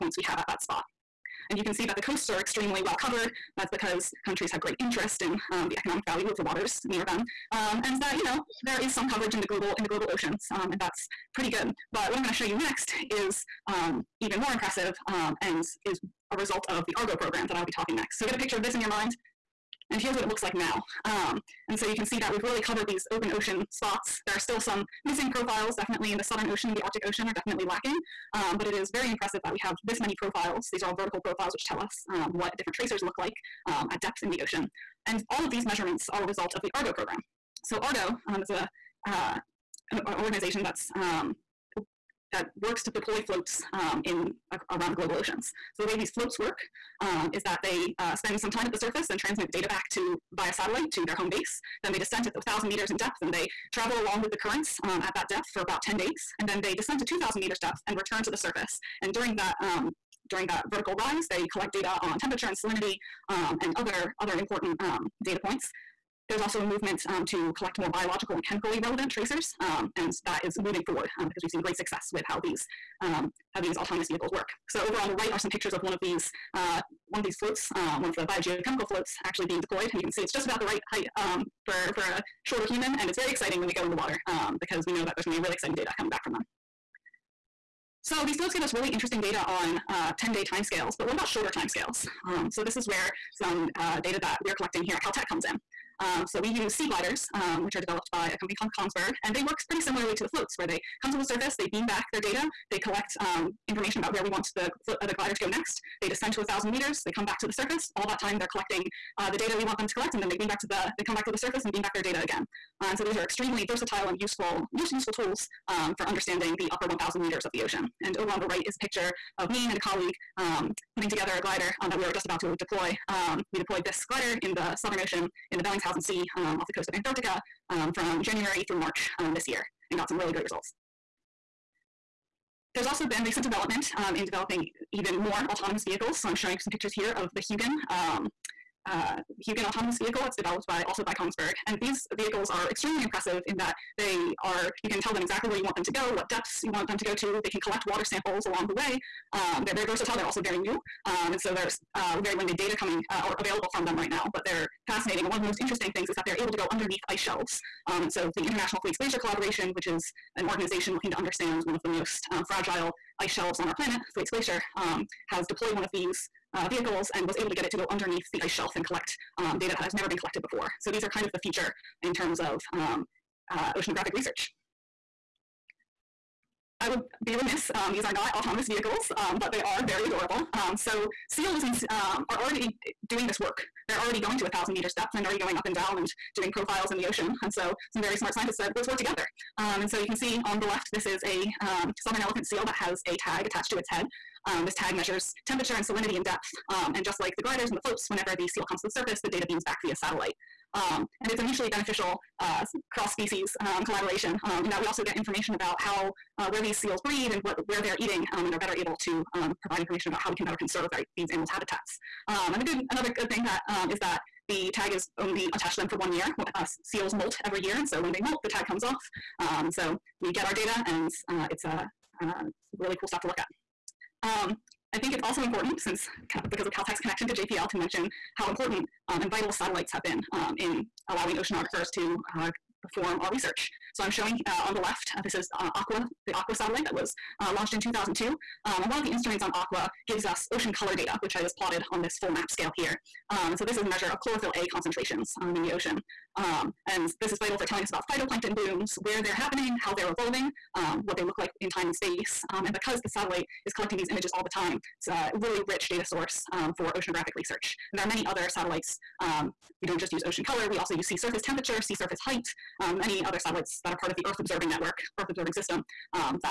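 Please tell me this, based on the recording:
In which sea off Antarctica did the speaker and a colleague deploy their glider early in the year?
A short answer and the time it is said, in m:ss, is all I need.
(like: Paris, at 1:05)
Bellingshausen Sea, at 2:05.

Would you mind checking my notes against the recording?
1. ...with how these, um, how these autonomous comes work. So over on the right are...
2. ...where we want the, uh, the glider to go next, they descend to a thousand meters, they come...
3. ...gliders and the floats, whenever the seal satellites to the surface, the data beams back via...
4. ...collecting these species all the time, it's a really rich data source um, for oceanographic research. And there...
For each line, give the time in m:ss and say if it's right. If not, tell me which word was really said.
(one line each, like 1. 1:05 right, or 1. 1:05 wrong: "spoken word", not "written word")
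1. 1:12 wrong: "vehicles", not "comes"
2. 1:44 right
3. 3:17 wrong: "comes", not "satellites"
4. 4:13 wrong: "images", not "species".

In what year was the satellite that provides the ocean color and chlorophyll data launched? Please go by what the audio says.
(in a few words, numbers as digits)
2002.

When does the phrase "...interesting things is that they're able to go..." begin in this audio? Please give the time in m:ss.
2:35.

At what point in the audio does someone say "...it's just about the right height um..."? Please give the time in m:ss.
1:20.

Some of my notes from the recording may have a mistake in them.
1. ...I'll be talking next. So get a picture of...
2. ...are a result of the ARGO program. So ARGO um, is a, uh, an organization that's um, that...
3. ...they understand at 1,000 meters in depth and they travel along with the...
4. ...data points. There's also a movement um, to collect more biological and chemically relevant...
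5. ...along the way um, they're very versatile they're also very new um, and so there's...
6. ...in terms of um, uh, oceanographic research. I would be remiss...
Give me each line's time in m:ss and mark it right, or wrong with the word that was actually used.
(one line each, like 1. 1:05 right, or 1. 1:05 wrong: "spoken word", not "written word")
1. 0:17 right
2. 0:36 right
3. 0:51 wrong: "descend", not "understand"
4. 1:05 right
5. 2:28 right
6. 2:52 right.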